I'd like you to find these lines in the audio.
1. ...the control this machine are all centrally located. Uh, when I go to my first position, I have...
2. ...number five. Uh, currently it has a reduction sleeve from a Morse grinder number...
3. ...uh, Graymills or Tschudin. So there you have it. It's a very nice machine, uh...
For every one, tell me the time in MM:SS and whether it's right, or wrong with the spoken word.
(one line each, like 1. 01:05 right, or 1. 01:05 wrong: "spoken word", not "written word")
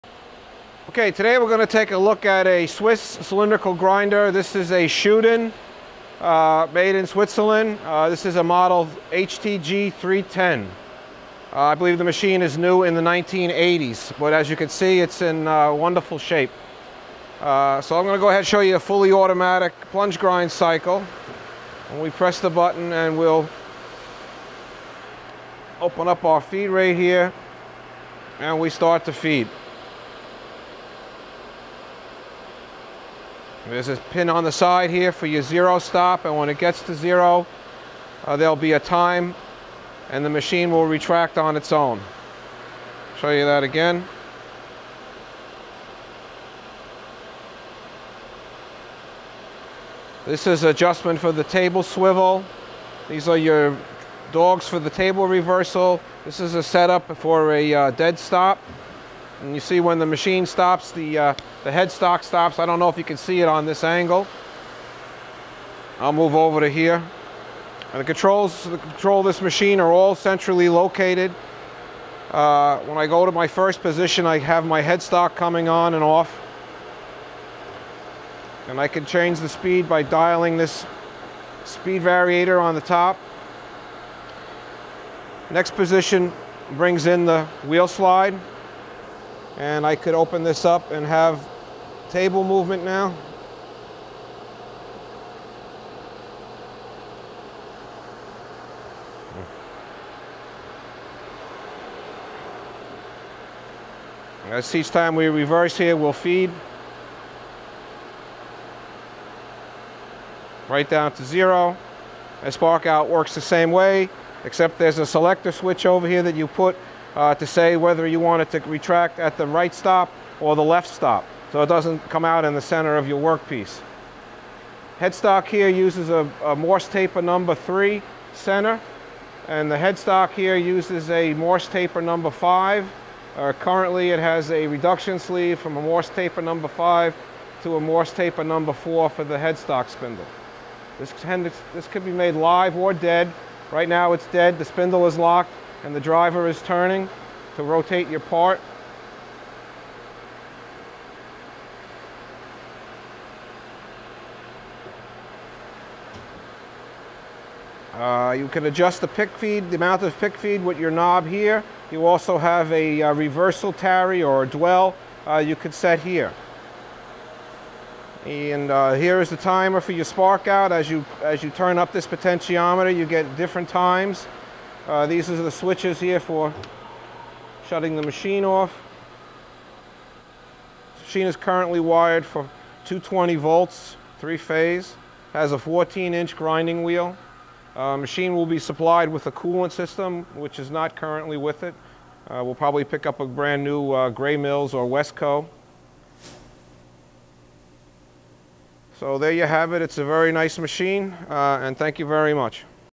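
1. 01:08 right
2. 02:12 wrong: "taper", not "grinder"
3. 03:13 wrong: "Westco", not "Tschudin".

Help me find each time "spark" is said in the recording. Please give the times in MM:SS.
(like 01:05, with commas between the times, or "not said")
01:52, 02:50.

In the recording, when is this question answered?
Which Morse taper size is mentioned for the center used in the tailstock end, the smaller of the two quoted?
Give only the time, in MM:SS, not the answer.
02:06.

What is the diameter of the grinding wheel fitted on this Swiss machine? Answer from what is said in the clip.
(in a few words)
14 inch.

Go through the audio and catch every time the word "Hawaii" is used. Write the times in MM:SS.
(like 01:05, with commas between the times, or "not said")
not said.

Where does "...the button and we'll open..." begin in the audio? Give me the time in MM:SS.
00:22.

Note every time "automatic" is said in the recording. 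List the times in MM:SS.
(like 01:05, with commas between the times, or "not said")
00:19.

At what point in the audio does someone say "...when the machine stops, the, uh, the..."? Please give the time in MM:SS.
00:59.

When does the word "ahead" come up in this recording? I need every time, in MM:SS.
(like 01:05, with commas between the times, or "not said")
00:18.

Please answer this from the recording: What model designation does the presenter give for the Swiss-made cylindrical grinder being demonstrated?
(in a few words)
HTG 310.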